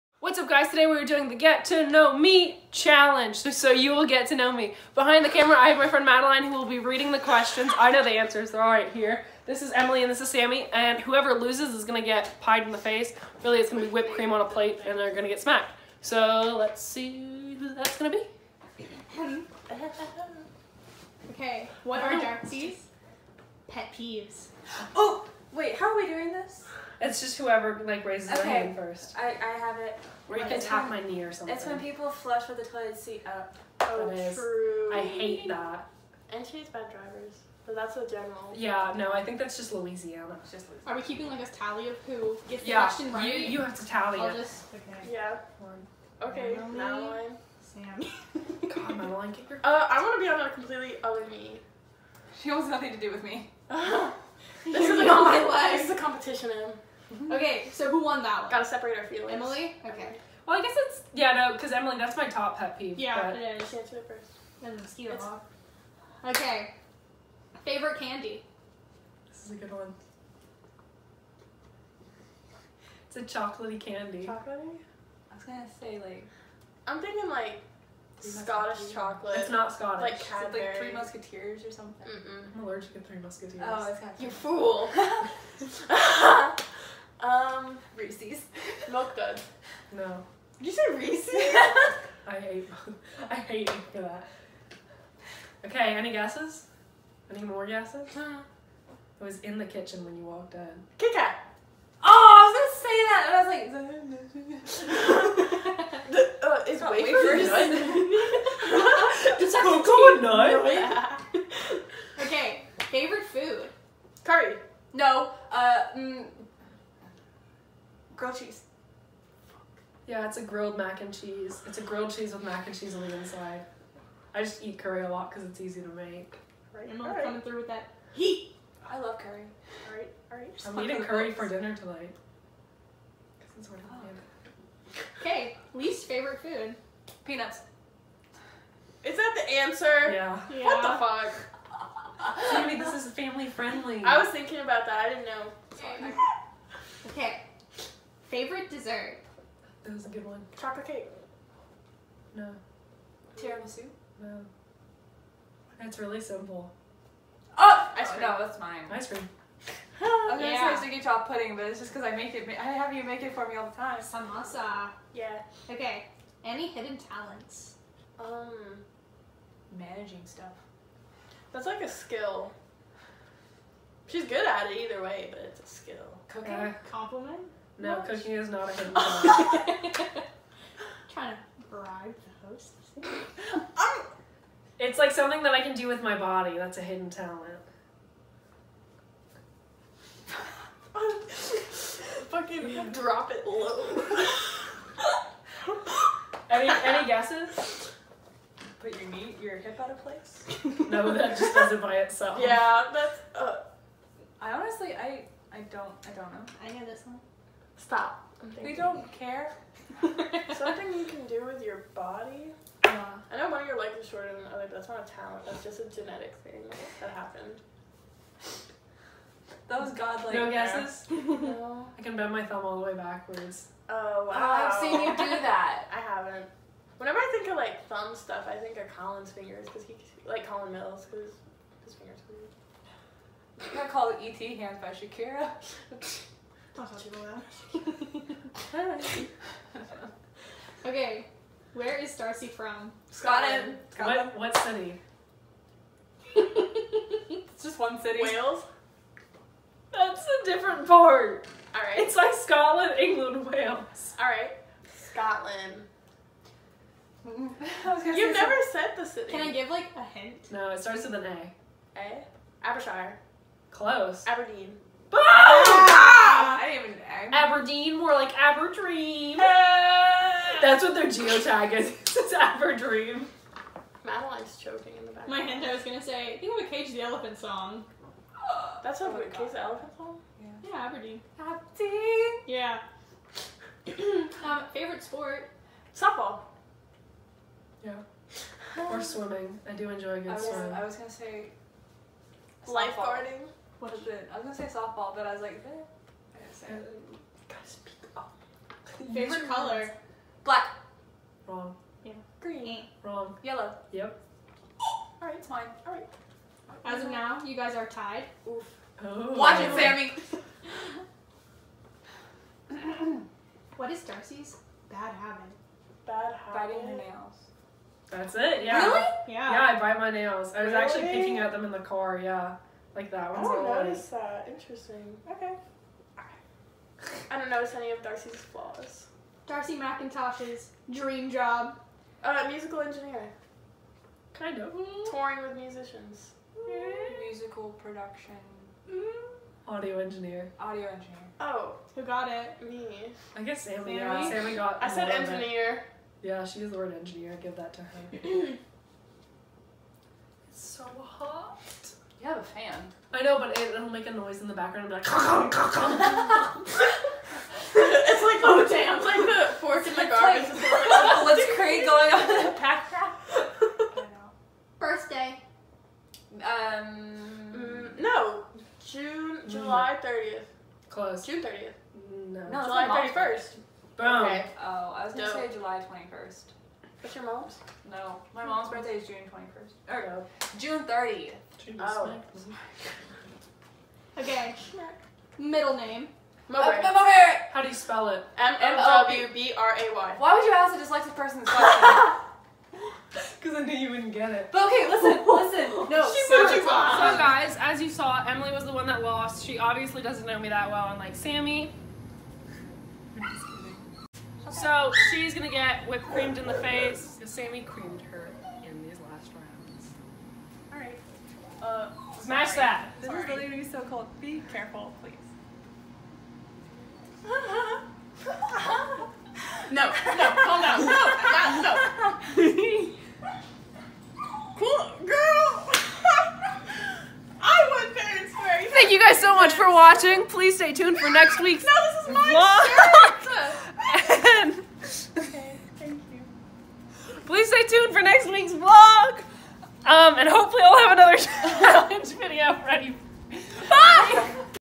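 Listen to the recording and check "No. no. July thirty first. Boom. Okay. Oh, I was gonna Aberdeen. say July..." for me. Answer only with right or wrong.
wrong.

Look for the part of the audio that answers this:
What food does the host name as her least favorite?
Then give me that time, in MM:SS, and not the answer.
02:17.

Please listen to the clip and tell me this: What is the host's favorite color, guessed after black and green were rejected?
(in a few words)
Yellow.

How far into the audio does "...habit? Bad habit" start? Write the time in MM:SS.
05:15.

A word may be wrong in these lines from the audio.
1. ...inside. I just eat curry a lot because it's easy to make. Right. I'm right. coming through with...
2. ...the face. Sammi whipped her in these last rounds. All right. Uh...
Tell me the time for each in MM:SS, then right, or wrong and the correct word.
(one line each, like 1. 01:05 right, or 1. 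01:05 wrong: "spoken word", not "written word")
1. 02:03 right
2. 06:46 wrong: "creamed", not "whipped".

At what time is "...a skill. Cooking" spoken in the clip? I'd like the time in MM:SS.
02:55.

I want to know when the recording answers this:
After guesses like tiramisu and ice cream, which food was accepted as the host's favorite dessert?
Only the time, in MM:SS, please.
02:43.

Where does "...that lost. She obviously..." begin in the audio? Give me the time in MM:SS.
06:38.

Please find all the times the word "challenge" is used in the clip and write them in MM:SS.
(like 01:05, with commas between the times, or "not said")
00:02, 07:21.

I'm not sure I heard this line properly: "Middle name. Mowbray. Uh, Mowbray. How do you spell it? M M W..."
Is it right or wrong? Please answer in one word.
right.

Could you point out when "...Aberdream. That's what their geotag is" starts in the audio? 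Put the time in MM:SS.
04:28.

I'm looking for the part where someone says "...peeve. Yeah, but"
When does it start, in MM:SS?
01:02.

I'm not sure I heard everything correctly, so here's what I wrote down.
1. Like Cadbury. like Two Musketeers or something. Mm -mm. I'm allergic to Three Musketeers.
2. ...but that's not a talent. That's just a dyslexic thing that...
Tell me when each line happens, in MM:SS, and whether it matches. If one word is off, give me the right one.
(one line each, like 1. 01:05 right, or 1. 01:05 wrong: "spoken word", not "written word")
1. 01:20 wrong: "Three", not "Two"
2. 03:34 wrong: "genetic", not "dyslexic".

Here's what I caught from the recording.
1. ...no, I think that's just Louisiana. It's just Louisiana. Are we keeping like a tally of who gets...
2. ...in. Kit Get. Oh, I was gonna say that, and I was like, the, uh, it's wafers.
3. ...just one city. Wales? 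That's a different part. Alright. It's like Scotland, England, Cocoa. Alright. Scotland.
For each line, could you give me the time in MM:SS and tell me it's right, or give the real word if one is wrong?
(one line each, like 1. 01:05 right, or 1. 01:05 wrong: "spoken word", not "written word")
1. 00:38 right
2. 01:40 wrong: "Kat", not "Get"
3. 04:07 wrong: "Wales", not "Cocoa".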